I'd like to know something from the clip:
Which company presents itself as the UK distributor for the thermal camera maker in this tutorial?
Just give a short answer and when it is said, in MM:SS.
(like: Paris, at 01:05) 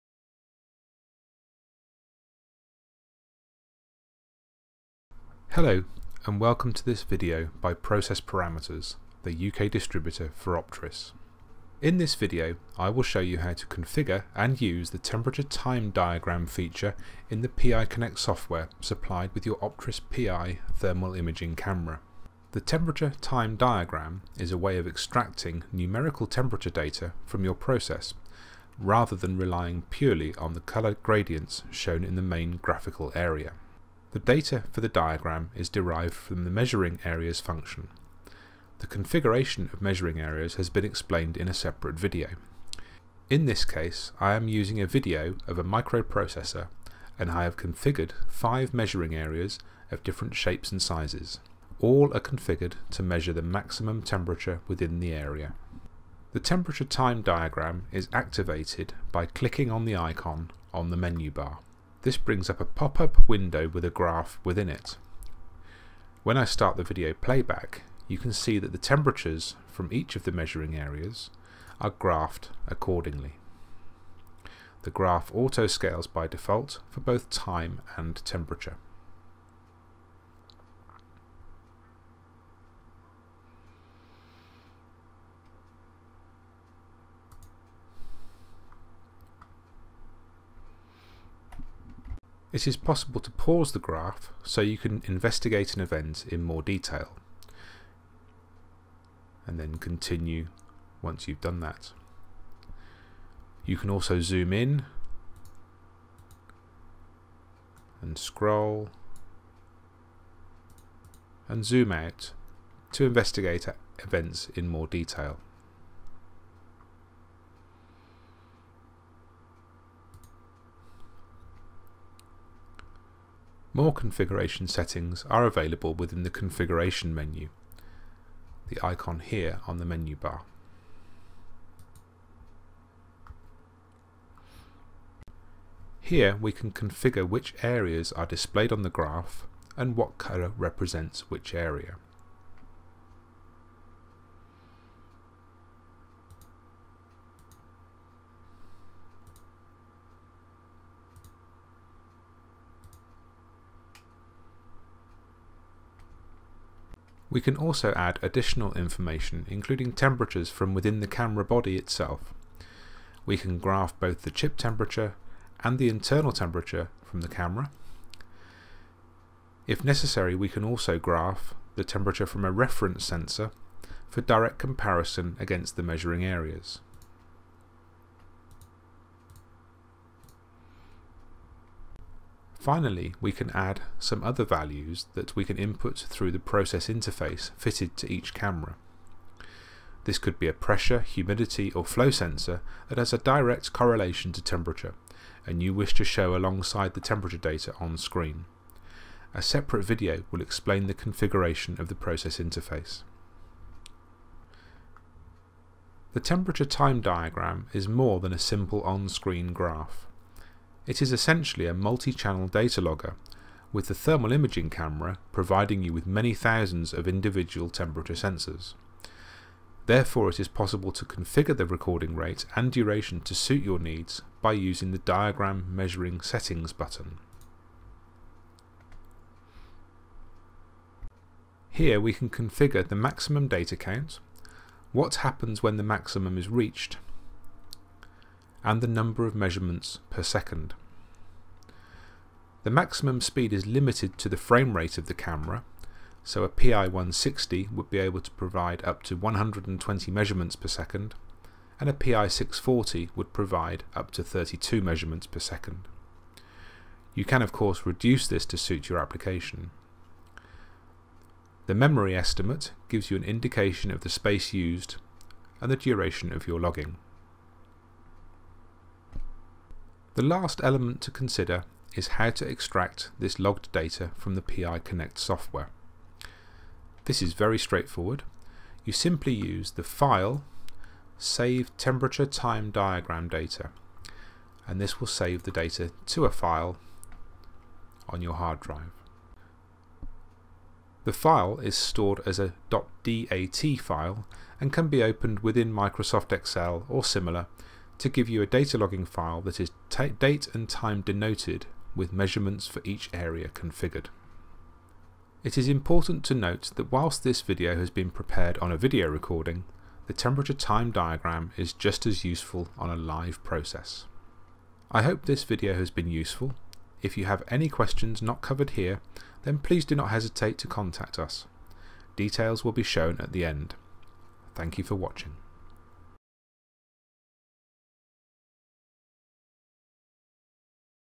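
Process Parameters, at 00:07.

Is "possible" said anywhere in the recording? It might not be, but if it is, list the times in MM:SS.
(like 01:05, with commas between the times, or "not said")
01:32, 03:40.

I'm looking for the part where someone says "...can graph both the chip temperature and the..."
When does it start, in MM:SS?
02:43.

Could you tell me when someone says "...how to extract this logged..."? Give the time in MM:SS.
04:32.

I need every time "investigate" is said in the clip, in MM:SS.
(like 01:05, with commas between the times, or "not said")
01:35, 01:53.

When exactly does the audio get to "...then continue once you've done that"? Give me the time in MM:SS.
01:39.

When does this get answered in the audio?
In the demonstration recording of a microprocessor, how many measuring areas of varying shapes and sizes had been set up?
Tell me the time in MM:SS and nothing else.
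00:48.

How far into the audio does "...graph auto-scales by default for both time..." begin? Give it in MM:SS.
01:14.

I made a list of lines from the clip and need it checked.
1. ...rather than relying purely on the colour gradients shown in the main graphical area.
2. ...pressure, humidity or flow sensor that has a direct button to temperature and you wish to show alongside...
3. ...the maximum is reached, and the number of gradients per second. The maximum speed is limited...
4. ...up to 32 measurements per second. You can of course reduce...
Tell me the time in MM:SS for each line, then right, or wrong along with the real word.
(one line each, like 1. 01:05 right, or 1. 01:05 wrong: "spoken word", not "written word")
1. 00:28 right
2. 03:10 wrong: "correlation", not "button"
3. 03:55 wrong: "measurements", not "gradients"
4. 04:13 right.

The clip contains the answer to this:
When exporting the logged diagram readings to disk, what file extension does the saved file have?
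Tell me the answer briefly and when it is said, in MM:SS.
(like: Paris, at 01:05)
.dat, at 04:52.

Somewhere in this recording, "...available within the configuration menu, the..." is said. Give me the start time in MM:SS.
02:05.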